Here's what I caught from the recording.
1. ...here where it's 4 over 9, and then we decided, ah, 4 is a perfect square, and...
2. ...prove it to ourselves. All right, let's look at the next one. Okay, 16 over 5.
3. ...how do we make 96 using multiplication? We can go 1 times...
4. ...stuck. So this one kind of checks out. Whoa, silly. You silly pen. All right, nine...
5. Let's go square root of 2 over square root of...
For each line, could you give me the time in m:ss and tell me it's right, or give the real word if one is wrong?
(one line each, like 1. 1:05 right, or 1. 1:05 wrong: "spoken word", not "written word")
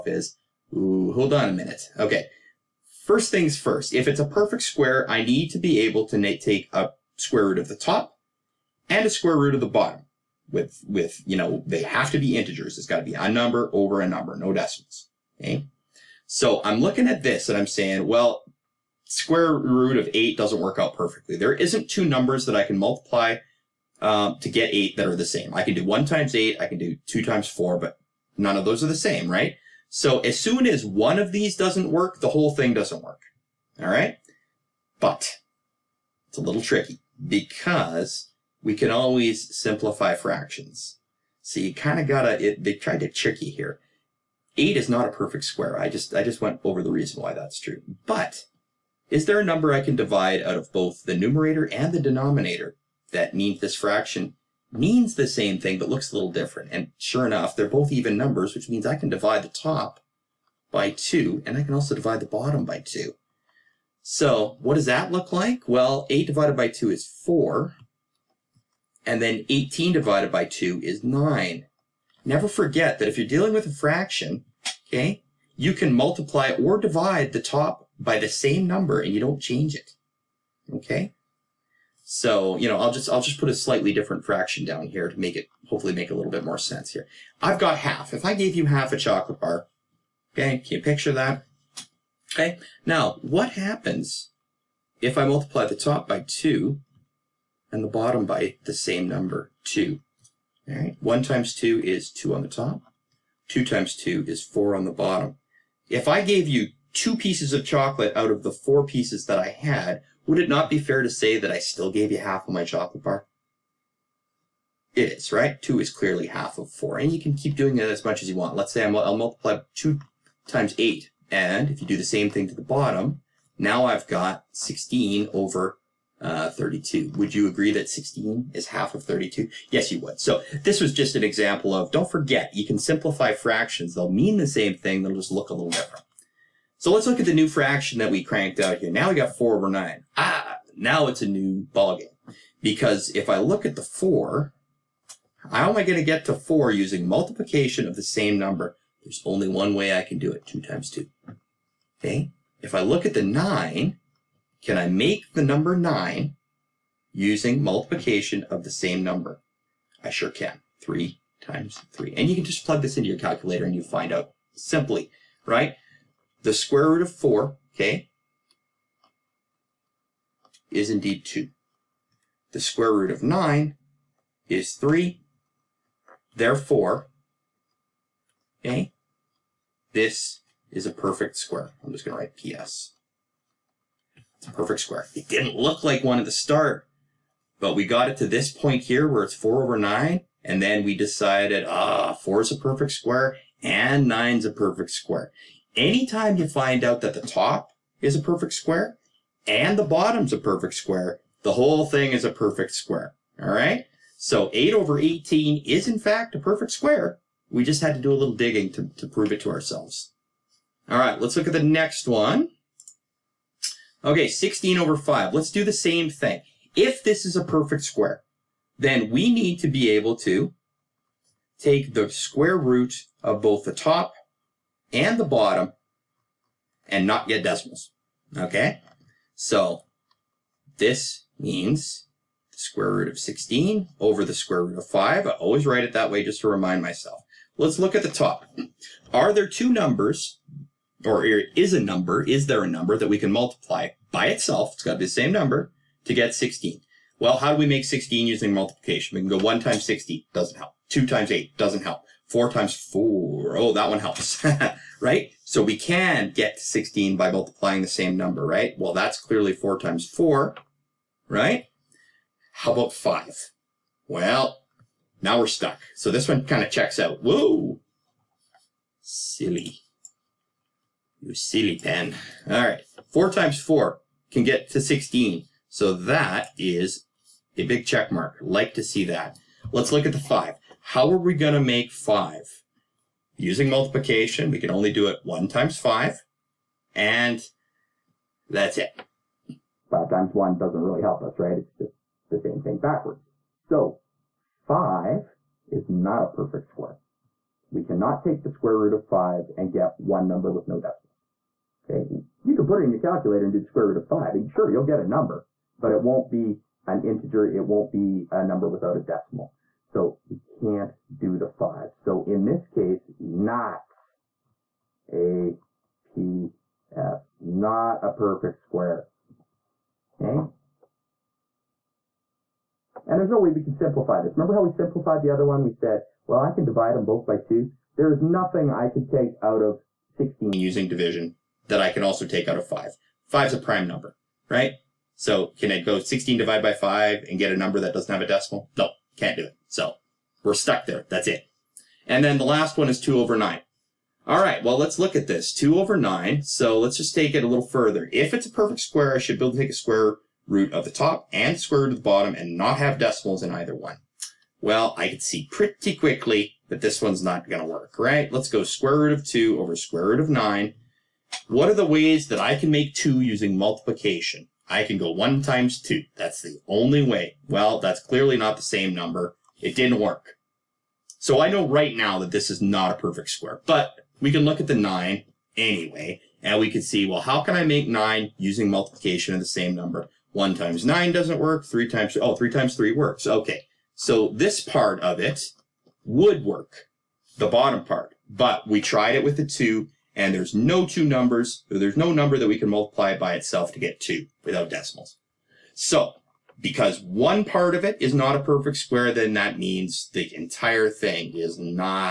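1. 3:08 right
2. 3:29 right
3. 4:07 wrong: "16", not "96"
4. 4:25 wrong: "four", not "nine"
5. 5:58 right.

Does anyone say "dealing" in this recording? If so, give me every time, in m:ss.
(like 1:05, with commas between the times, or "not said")
1:13.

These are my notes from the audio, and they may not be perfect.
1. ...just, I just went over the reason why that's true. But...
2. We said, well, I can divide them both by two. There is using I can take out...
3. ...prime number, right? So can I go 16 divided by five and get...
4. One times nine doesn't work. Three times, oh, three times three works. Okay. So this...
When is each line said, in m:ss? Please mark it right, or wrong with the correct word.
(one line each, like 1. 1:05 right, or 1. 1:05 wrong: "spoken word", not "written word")
1. 0:45 right
2. 5:25 wrong: "nothing", not "using"
3. 5:33 right
4. 6:20 right.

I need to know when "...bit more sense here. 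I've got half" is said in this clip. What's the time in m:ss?
1:26.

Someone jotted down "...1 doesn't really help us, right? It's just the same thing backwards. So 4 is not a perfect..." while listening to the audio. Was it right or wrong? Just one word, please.
wrong.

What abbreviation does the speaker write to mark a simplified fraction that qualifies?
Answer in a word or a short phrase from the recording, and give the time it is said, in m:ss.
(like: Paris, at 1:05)
PS, at 3:02.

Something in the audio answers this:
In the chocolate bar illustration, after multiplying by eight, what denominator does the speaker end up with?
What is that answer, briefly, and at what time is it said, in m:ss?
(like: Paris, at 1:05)
32, at 2:04.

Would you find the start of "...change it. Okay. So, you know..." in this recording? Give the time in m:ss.
1:19.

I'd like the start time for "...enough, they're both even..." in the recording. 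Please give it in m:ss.
0:57.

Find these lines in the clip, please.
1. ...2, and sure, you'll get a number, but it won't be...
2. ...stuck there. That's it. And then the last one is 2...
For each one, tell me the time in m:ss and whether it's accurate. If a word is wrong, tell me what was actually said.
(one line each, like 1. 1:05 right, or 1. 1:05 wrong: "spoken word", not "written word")
1. 5:04 wrong: "5", not "2"
2. 5:40 right.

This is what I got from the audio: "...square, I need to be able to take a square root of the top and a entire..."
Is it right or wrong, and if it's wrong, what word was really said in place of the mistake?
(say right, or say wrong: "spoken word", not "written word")
wrong: "square", not "entire".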